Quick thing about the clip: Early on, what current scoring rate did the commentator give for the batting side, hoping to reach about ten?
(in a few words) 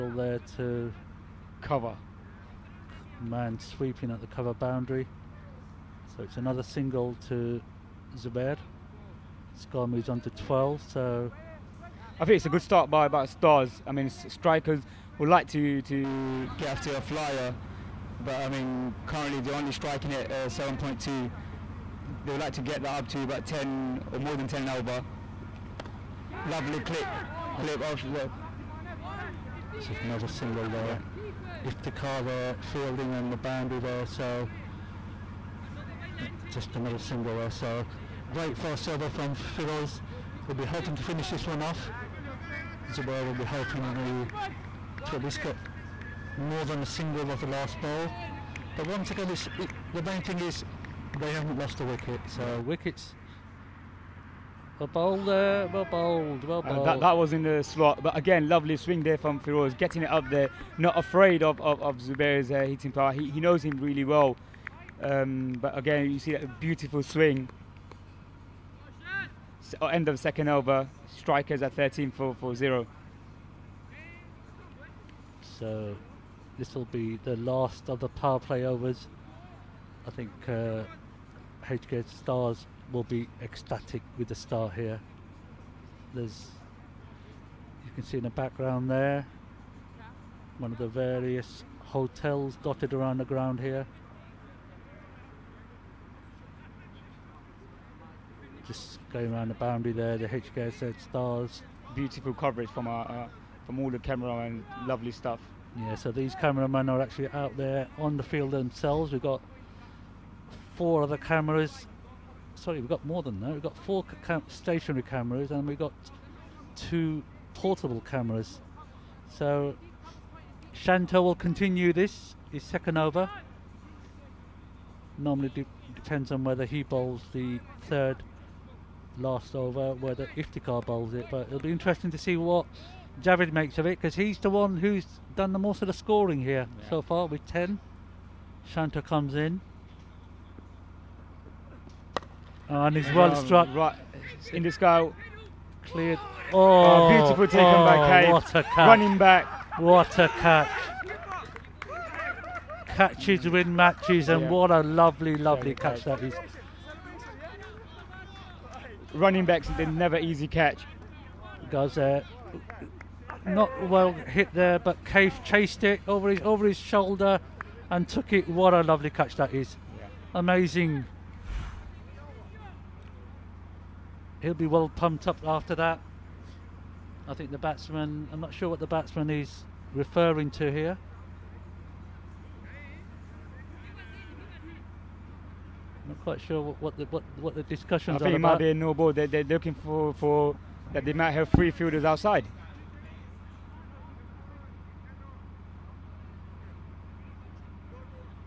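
7.2.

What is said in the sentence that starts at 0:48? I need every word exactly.
But once again, it's it, the main thing is they haven't lost a wicket.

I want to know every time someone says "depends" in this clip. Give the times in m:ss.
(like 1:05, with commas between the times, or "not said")
2:05.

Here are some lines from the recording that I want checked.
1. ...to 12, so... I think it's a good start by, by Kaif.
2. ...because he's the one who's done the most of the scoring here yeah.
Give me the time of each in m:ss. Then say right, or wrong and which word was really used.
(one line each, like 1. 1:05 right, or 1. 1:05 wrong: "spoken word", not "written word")
1. 0:10 wrong: "Stars", not "Kaif"
2. 2:13 right.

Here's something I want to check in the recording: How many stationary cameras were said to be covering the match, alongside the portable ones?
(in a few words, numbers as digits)
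4.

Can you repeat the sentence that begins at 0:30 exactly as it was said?
Yeah if they car there fielding on the boundary there.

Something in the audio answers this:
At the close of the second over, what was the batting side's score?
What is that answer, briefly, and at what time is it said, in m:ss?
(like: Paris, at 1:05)
13 for 0, at 1:11.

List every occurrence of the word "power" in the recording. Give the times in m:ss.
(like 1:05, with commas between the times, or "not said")
1:02, 1:18.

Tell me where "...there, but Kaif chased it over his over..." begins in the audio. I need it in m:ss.
2:44.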